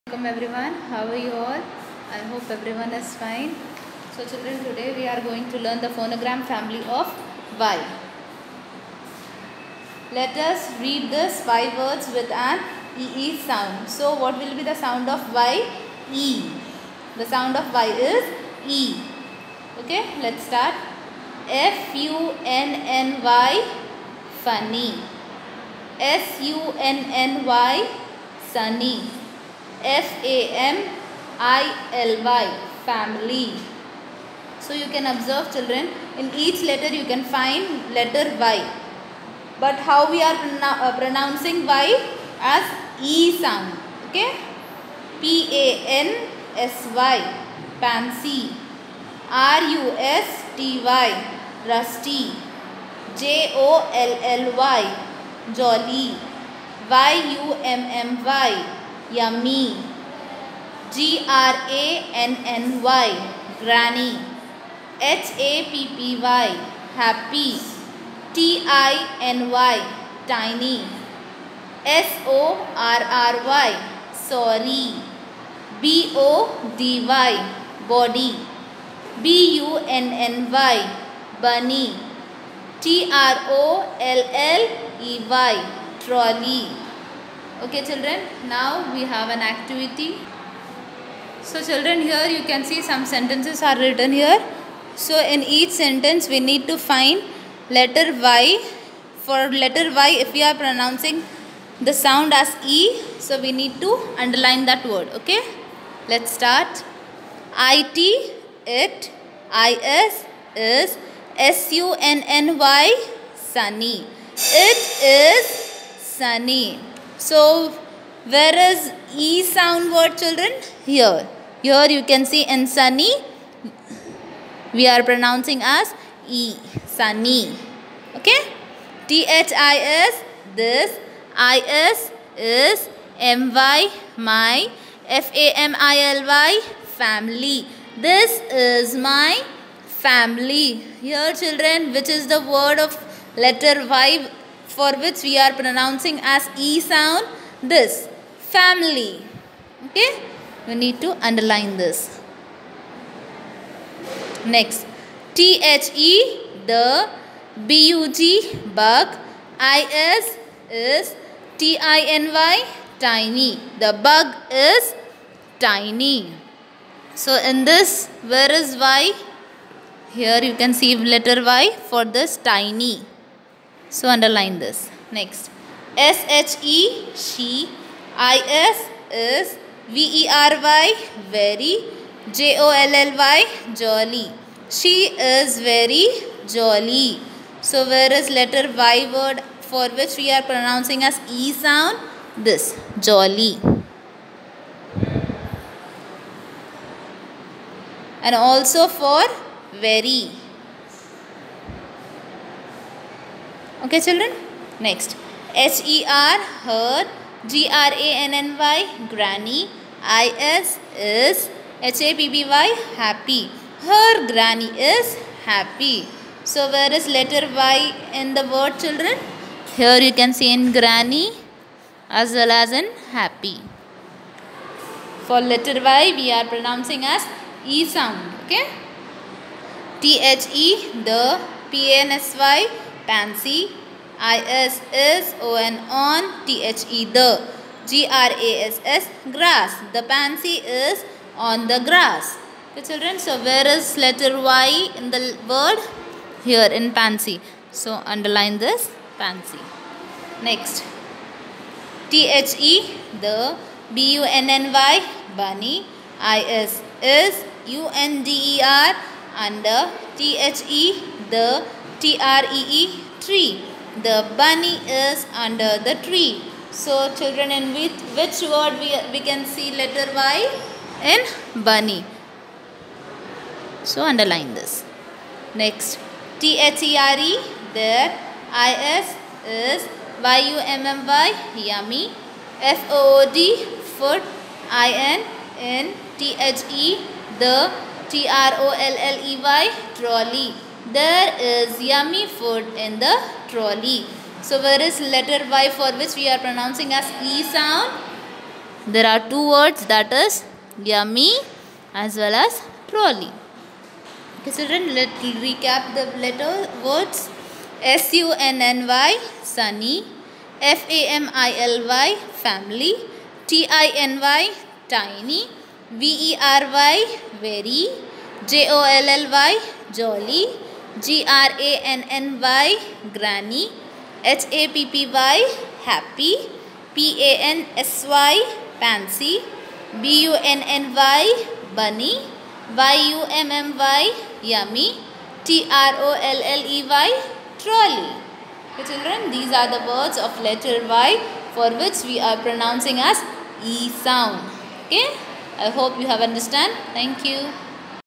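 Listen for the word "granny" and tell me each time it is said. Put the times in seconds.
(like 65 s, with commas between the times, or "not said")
209 s, 214 s, 220 s, 323 s.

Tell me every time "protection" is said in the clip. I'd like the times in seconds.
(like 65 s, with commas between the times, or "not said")
not said.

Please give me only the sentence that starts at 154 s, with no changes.
Next, T H E the B U G bug I S is T I N Y tiny.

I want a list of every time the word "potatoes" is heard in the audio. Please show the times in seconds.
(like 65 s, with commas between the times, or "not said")
not said.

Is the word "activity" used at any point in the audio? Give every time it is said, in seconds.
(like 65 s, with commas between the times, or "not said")
89 s.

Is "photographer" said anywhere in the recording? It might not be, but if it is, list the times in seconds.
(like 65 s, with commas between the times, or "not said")
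not said.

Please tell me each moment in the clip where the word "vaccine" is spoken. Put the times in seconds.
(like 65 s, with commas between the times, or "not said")
not said.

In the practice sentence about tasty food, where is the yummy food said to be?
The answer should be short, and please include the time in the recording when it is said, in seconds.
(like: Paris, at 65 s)
in the trolley, at 286 s.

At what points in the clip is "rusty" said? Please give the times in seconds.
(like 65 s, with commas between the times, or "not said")
51 s.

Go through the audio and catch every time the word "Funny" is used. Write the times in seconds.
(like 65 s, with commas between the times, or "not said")
24 s.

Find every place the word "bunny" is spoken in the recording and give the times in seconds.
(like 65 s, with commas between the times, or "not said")
255 s, 264 s, 271 s, 331 s.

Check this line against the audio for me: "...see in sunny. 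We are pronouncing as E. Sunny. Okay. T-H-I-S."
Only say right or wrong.
right.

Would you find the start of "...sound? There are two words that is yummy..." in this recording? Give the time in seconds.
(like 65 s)
297 s.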